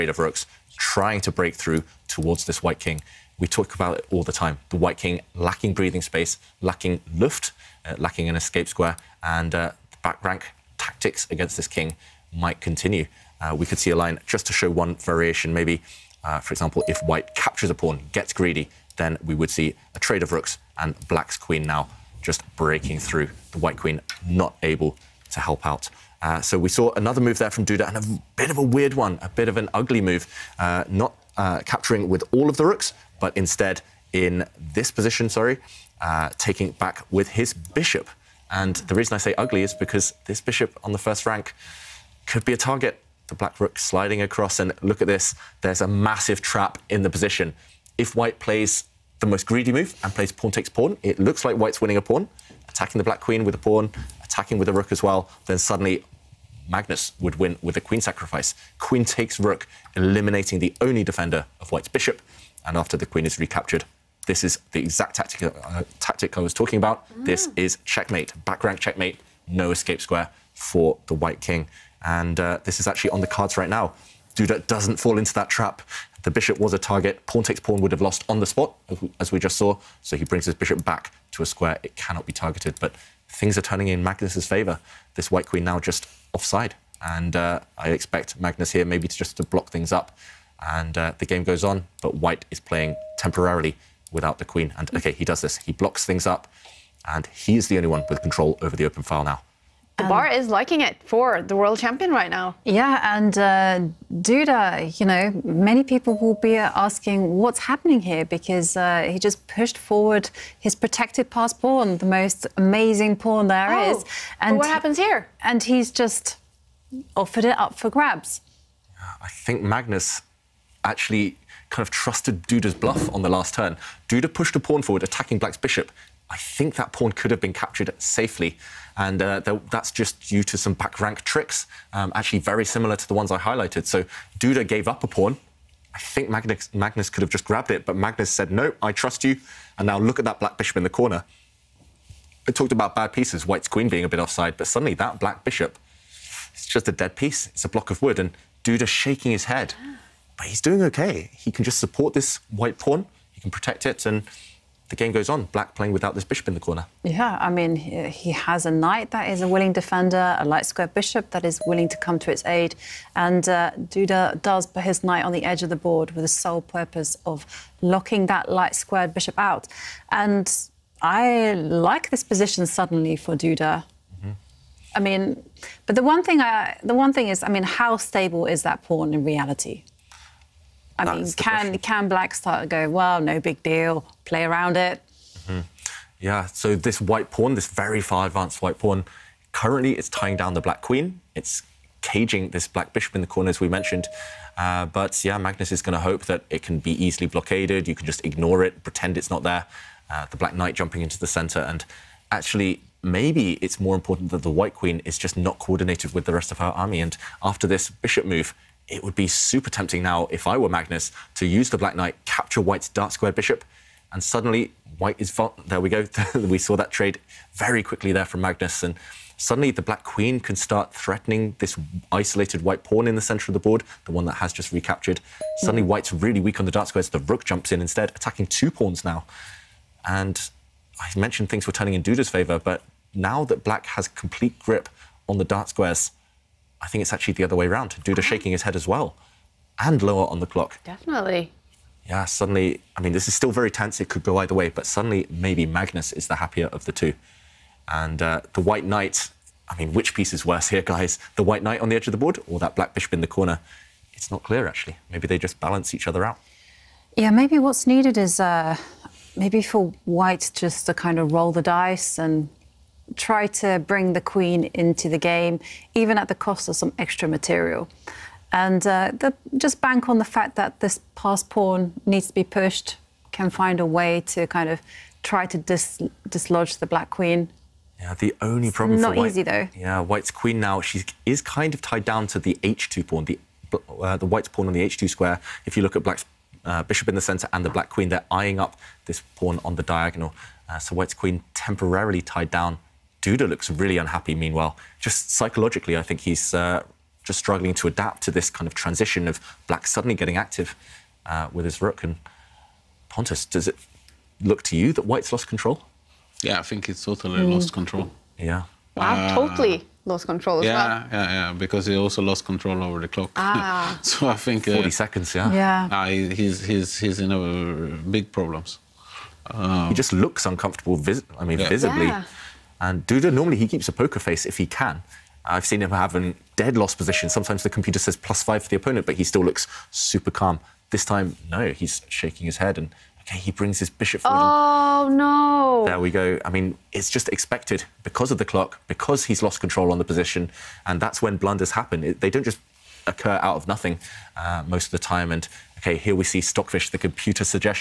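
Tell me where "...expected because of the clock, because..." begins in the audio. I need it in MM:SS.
05:37.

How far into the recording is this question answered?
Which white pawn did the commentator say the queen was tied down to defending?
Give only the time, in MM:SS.
04:42.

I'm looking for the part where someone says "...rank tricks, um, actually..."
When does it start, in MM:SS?
02:10.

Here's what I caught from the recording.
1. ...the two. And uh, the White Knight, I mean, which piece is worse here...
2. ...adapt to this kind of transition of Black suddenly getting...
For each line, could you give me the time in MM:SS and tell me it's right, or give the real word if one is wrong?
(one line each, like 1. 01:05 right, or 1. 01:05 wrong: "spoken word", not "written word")
1. 04:06 right
2. 04:57 right.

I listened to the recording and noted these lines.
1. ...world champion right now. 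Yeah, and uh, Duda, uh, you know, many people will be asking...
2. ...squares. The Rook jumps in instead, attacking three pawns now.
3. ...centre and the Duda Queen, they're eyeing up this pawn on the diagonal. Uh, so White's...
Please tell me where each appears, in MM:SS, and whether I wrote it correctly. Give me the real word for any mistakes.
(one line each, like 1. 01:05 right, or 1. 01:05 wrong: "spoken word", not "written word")
1. 01:41 right
2. 03:46 wrong: "two", not "three"
3. 04:47 wrong: "Black", not "Duda".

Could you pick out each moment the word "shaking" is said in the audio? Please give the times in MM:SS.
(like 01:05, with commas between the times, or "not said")
02:28, 03:58, 05:32.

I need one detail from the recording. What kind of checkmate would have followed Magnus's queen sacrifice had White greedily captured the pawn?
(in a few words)
Back rank checkmate.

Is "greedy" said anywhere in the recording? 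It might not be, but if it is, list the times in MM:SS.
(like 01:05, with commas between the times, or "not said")
00:18, 00:49.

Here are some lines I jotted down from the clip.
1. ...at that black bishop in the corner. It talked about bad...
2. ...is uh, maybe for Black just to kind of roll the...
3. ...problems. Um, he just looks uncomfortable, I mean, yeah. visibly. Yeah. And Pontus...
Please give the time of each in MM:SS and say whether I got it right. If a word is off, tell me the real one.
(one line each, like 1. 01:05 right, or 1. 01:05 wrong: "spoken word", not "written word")
1. 02:20 right
2. 04:18 wrong: "White", not "Black"
3. 05:18 wrong: "Duda", not "Pontus".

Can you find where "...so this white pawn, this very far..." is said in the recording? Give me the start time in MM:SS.
03:06.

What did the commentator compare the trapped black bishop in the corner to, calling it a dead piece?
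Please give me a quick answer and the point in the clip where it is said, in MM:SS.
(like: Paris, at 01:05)
A block of wood, at 02:27.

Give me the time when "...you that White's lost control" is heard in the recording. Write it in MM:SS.
05:04.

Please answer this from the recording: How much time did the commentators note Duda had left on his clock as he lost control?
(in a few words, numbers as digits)
40 seconds.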